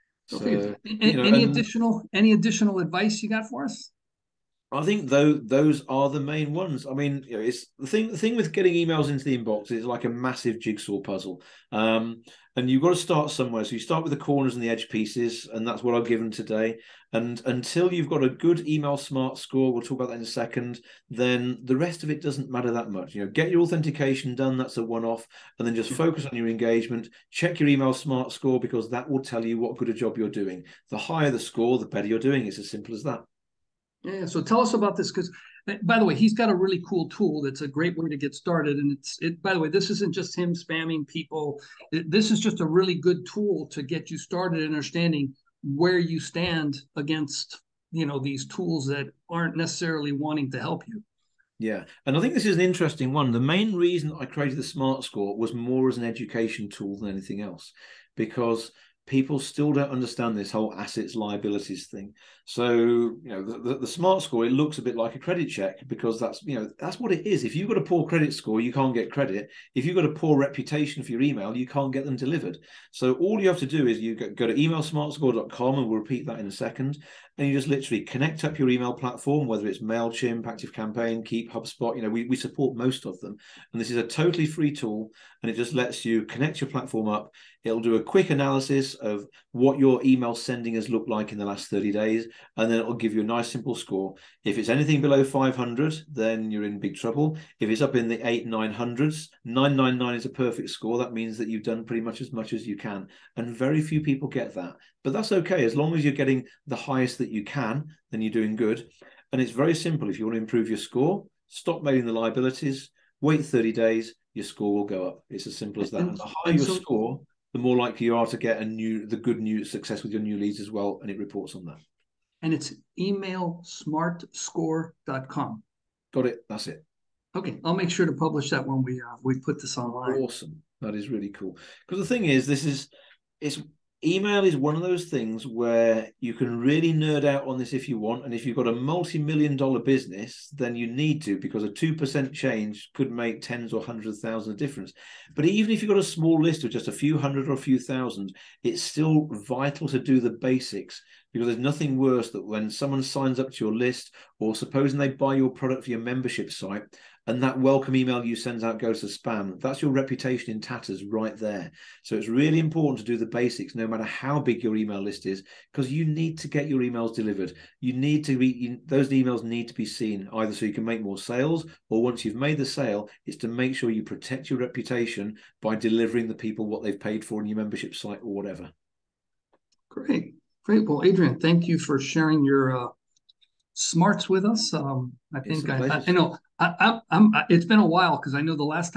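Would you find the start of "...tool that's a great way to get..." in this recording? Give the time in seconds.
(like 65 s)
37 s.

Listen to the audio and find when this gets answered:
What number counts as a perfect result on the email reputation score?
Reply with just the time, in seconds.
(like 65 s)
99 s.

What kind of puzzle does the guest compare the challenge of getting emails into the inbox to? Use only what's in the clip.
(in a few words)
Jigsaw puzzle.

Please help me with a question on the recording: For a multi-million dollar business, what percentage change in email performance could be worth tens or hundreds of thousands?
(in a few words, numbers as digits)
2%.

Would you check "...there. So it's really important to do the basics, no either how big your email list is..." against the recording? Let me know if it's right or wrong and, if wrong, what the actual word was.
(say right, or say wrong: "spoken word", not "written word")
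wrong: "matter", not "either".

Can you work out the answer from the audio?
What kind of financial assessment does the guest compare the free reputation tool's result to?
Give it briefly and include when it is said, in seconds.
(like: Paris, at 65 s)
A credit check, at 65 s.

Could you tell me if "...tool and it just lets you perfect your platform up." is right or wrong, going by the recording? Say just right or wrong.
wrong.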